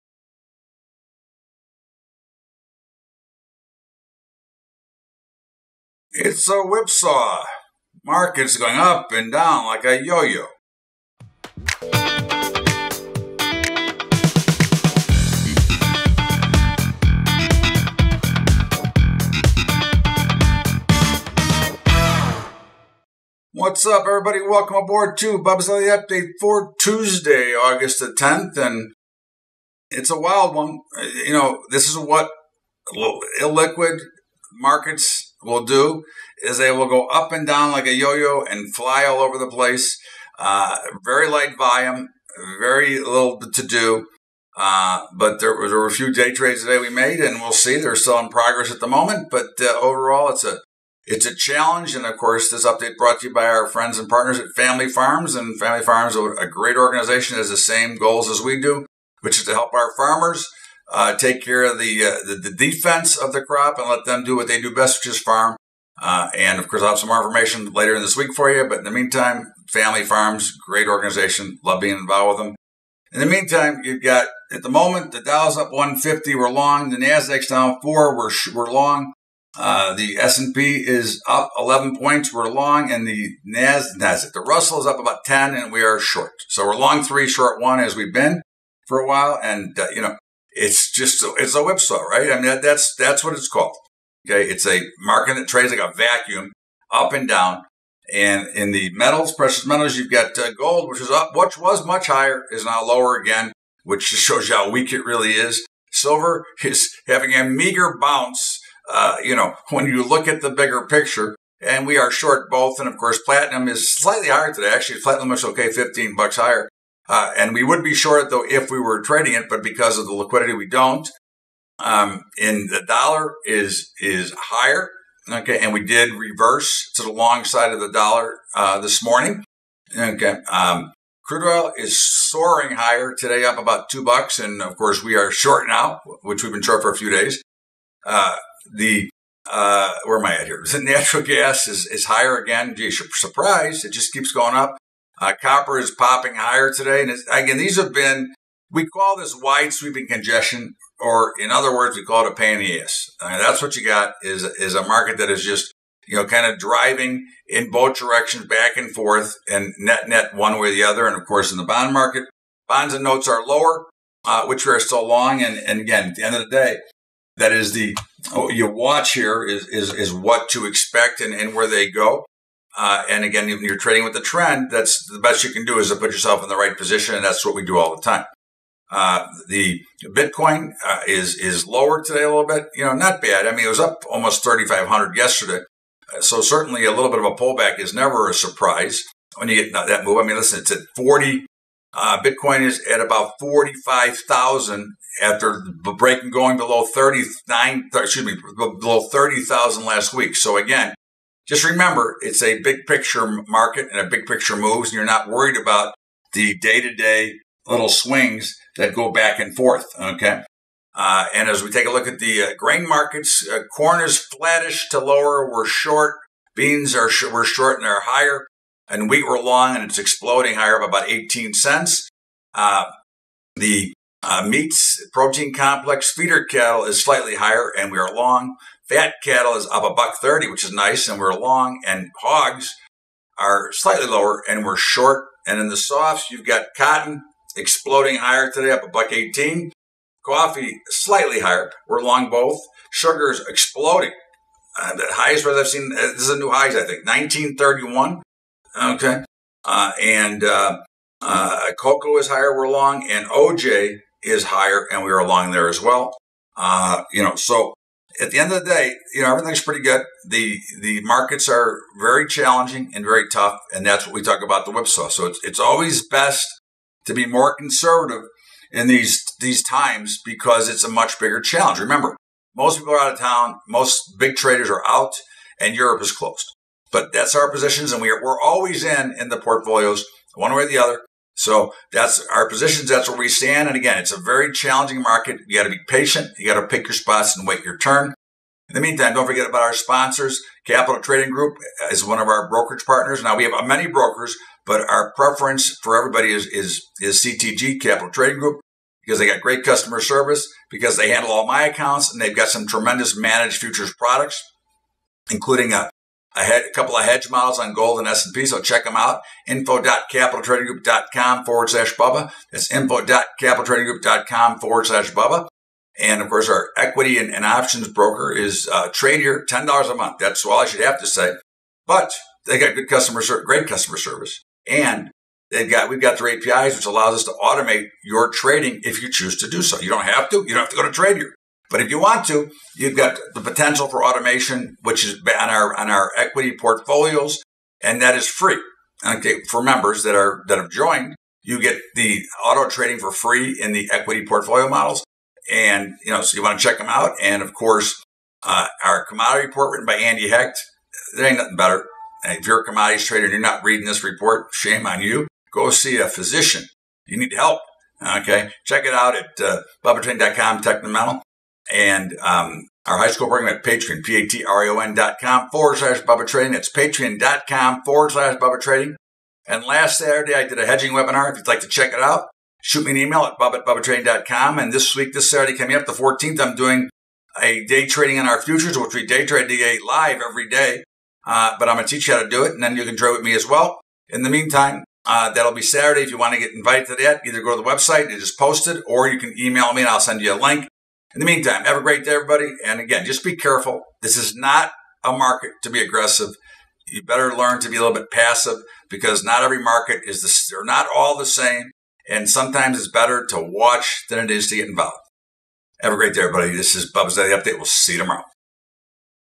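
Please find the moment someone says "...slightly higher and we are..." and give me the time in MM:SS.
03:47.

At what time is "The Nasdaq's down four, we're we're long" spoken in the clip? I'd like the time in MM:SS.
01:16.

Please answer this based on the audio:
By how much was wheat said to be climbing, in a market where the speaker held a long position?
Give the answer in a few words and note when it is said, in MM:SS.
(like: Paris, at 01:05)
18 cents, at 03:41.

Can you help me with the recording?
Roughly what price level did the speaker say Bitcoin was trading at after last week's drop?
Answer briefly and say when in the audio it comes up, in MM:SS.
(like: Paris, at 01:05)
45,000, at 03:13.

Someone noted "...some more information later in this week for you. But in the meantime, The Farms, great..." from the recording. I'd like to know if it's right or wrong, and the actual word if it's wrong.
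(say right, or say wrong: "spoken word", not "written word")
wrong: "Family", not "The".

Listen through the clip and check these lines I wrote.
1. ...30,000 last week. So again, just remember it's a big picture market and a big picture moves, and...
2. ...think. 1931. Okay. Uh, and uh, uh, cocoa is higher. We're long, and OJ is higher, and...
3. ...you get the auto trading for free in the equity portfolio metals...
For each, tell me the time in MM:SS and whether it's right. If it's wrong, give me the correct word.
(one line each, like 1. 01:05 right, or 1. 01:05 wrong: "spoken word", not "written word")
1. 03:19 right
2. 04:06 right
3. 05:41 wrong: "models", not "metals".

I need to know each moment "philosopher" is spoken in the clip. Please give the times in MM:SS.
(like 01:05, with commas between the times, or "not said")
not said.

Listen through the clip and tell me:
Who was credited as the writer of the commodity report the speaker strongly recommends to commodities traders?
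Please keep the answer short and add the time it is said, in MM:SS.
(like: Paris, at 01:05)
Andy Hecht, at 05:49.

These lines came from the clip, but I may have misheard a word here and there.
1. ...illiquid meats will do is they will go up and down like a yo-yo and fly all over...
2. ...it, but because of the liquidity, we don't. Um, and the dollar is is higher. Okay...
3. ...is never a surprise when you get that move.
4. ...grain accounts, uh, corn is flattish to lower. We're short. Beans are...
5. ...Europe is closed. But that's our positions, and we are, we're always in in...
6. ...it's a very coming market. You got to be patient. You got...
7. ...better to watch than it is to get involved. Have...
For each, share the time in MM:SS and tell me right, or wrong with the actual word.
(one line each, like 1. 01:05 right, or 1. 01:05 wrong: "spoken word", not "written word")
1. 00:32 wrong: "markets", not "meats"
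2. 01:59 right
3. 03:07 right
4. 03:32 wrong: "markets", not "accounts"
5. 04:35 right
6. 04:43 wrong: "challenging", not "coming"
7. 06:42 right.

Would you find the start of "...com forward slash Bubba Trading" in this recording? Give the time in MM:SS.
06:05.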